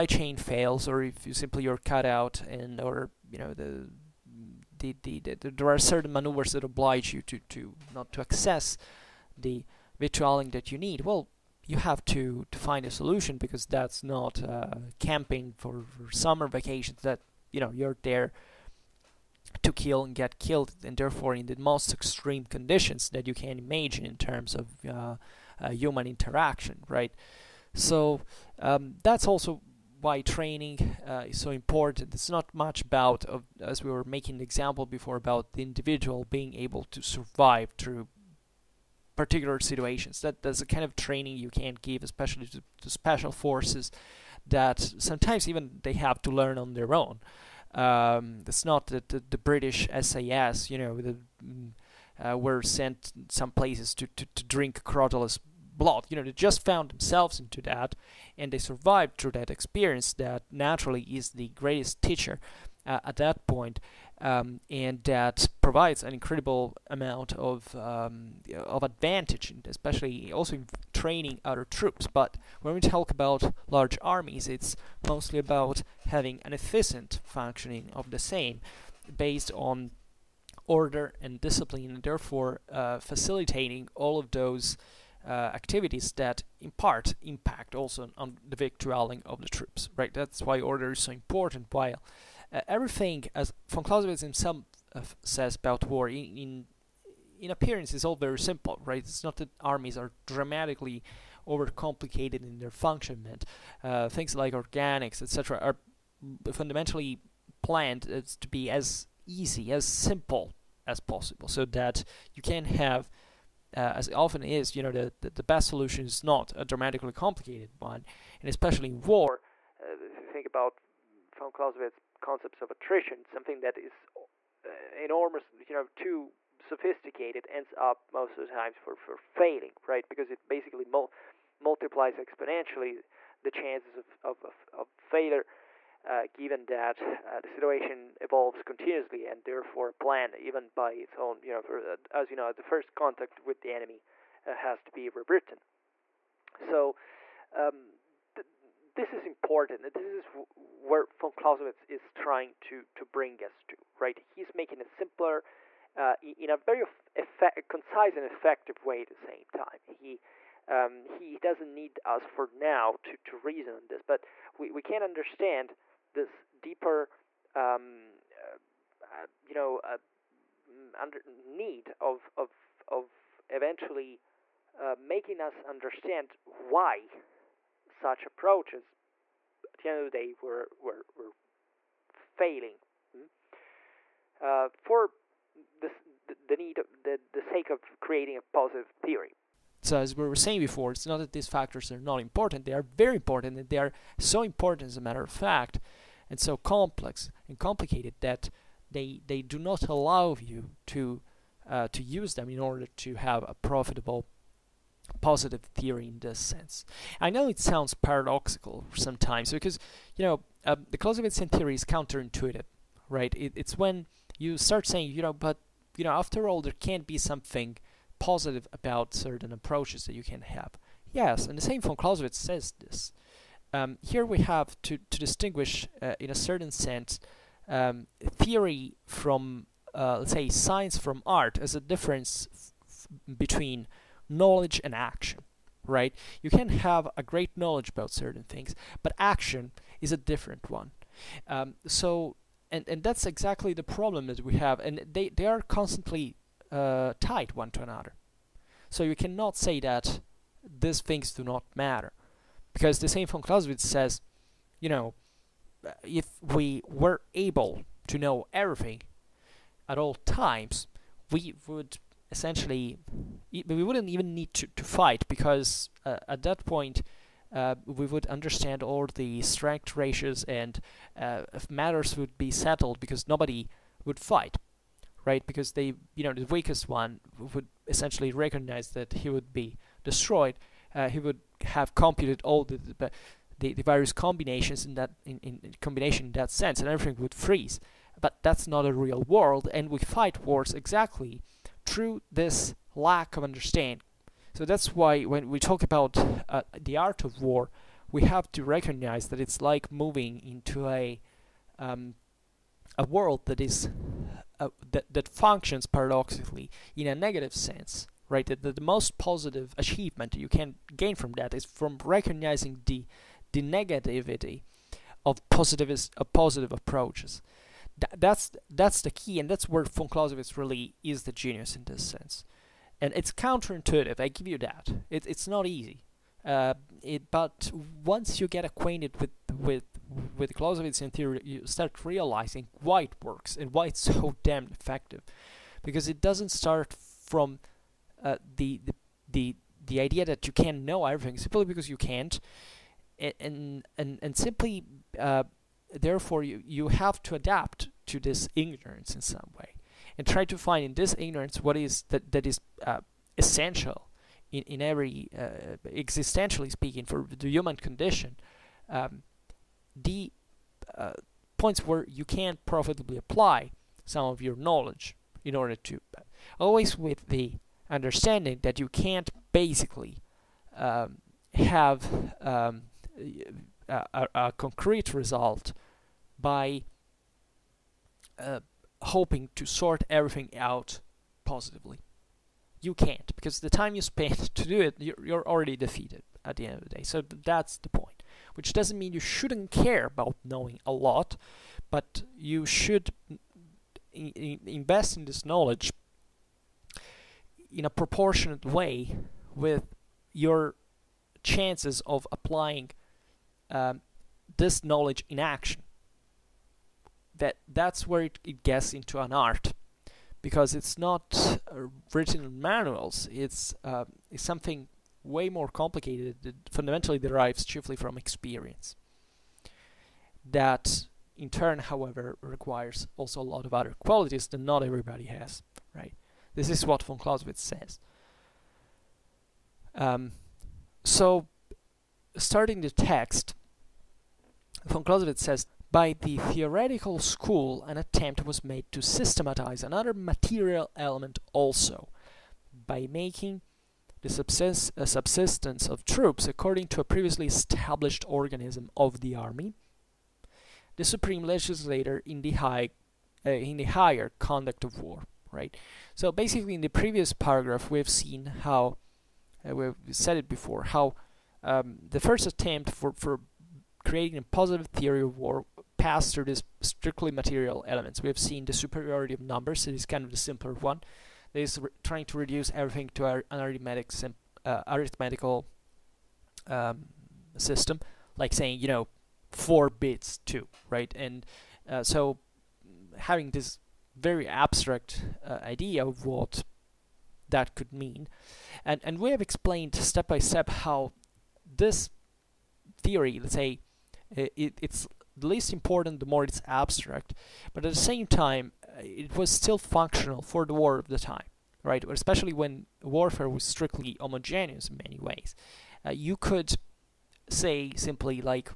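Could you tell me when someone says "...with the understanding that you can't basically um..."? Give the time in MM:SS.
06:06.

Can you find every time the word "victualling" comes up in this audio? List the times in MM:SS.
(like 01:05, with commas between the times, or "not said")
00:10, 01:28.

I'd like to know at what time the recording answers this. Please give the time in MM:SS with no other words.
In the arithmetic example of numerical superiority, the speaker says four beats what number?
08:00.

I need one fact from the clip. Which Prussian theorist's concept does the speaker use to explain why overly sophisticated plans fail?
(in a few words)
attrition.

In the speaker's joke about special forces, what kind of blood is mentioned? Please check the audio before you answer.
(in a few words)
Crotalus blood.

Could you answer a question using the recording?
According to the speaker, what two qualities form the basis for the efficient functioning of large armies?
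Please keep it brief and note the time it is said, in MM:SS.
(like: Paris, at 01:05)
order and discipline, at 01:20.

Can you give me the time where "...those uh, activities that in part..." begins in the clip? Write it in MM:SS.
01:24.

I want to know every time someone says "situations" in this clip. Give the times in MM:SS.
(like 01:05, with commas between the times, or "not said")
00:39, 02:17.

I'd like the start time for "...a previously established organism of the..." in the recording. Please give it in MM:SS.
07:27.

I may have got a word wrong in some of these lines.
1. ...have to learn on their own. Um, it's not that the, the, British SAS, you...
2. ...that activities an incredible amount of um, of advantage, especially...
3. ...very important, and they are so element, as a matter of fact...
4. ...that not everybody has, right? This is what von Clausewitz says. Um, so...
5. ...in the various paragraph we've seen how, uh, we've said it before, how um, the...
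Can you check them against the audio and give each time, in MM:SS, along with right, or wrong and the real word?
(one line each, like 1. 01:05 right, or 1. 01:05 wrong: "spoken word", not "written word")
1. 00:45 right
2. 01:05 wrong: "provides", not "activities"
3. 03:12 wrong: "important", not "element"
4. 07:04 right
5. 07:36 wrong: "previous", not "various".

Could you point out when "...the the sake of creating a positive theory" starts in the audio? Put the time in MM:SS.
03:07.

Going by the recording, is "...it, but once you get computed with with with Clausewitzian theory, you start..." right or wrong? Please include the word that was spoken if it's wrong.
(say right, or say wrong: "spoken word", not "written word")
wrong: "acquainted", not "computed".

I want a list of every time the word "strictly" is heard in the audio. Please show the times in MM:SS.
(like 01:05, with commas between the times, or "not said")
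07:46, 08:23.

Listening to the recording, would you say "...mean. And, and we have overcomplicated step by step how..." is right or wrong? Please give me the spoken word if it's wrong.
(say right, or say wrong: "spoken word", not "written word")
wrong: "explained", not "overcomplicated".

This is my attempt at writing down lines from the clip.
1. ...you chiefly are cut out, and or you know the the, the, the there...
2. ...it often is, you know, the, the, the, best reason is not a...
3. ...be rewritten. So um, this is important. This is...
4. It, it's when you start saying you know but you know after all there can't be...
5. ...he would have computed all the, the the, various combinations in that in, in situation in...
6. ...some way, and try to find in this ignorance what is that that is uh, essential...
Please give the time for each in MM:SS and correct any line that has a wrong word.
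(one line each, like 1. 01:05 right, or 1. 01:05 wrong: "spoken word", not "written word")
1. 00:01 wrong: "simply", not "chiefly"
2. 01:54 wrong: "solution", not "reason"
3. 02:24 right
4. 03:33 right
5. 04:41 wrong: "combination", not "situation"
6. 05:49 right.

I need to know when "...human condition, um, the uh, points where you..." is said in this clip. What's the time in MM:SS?
05:57.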